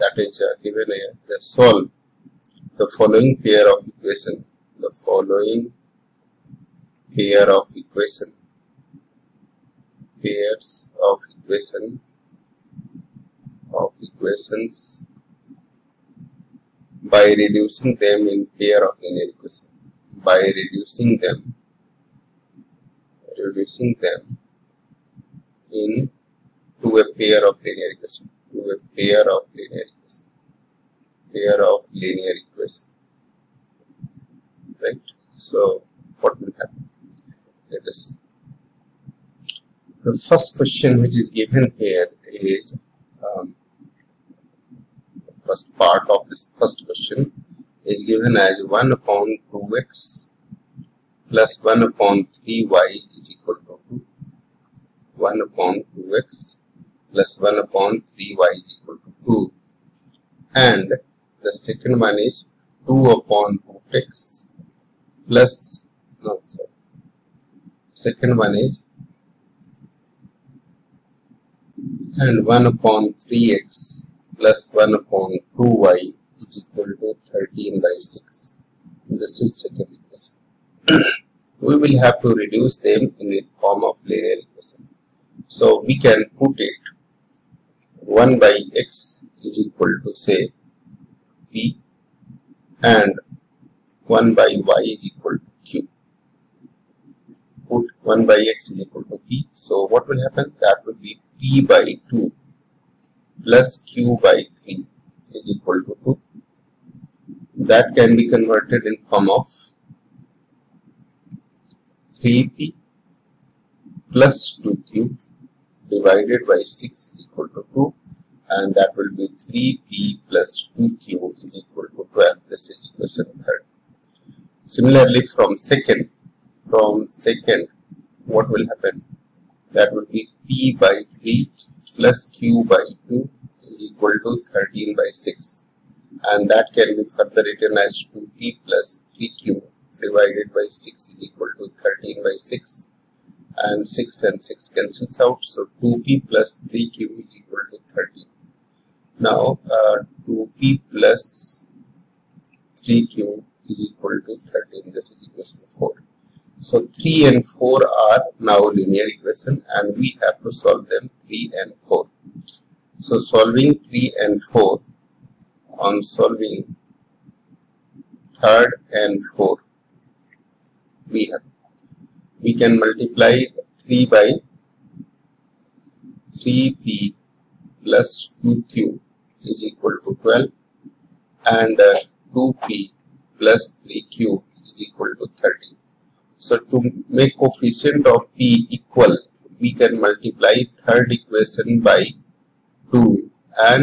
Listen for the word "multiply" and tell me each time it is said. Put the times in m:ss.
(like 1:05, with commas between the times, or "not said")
2:52, 3:10.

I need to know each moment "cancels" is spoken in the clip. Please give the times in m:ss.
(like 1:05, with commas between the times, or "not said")
2:24.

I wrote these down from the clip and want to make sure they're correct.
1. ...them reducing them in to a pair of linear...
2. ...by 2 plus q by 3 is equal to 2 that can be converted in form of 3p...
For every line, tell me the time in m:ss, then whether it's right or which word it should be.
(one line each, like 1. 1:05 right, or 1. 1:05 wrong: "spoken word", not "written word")
1. 0:21 right
2. 1:41 right.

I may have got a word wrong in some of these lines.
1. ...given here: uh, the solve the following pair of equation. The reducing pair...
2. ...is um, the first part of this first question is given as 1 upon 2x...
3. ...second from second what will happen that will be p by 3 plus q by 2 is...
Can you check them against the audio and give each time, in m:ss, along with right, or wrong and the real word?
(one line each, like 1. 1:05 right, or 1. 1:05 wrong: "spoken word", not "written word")
1. 0:00 wrong: "following", not "reducing"
2. 0:42 right
3. 2:05 right.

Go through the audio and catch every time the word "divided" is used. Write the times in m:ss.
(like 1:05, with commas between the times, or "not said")
1:55, 2:20.